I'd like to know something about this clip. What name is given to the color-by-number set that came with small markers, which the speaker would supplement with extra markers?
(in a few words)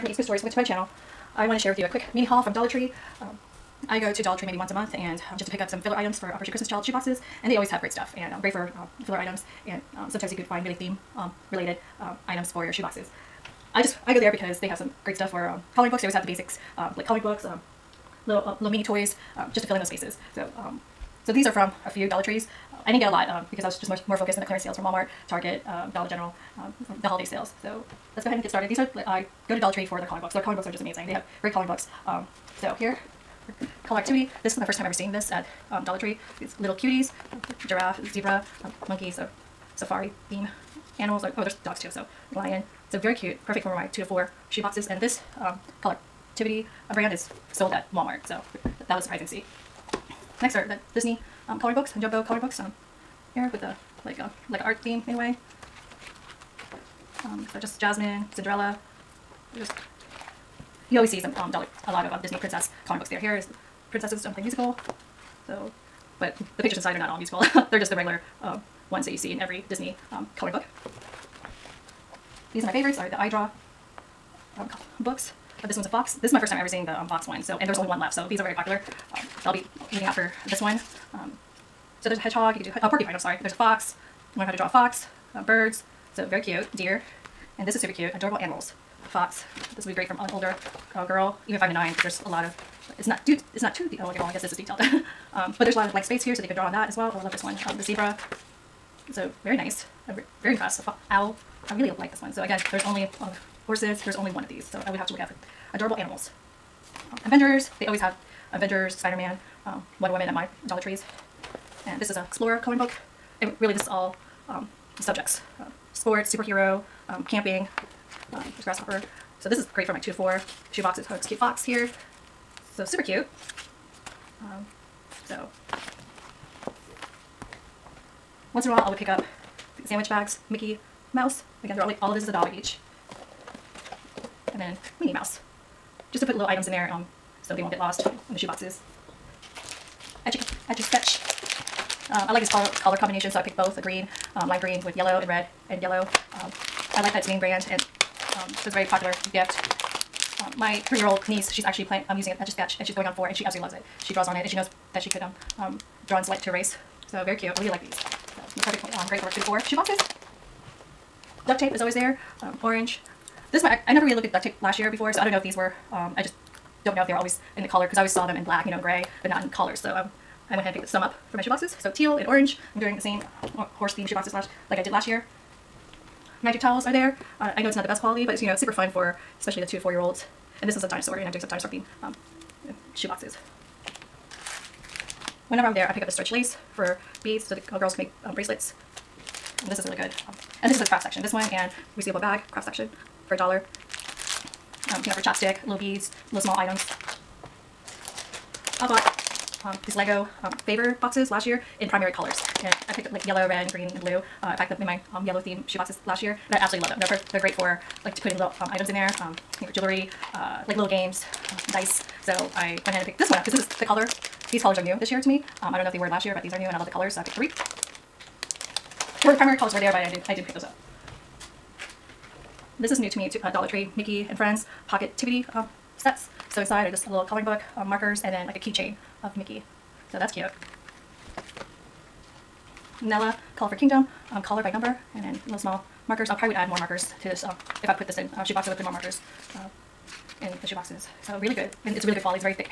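Colorful Kingdom.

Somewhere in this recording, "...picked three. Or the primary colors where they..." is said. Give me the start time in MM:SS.
03:37.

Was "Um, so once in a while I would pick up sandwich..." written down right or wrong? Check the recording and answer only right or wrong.
right.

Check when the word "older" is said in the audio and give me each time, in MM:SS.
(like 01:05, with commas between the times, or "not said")
01:30.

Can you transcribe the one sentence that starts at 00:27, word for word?
So let's go ahead and get started.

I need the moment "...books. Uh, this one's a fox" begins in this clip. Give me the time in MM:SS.
01:14.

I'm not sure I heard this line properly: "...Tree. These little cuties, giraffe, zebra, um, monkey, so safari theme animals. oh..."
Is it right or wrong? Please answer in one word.
right.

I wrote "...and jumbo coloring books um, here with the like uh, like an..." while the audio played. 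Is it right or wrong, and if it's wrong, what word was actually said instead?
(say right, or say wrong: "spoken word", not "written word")
right.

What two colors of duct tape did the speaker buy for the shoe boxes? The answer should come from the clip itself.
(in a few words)
Teal and orange.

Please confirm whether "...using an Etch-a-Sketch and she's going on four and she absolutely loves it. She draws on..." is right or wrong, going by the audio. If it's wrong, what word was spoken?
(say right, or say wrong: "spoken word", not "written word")
right.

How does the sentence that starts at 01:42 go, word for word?
So again, there's only oh, horses, there's only one of these.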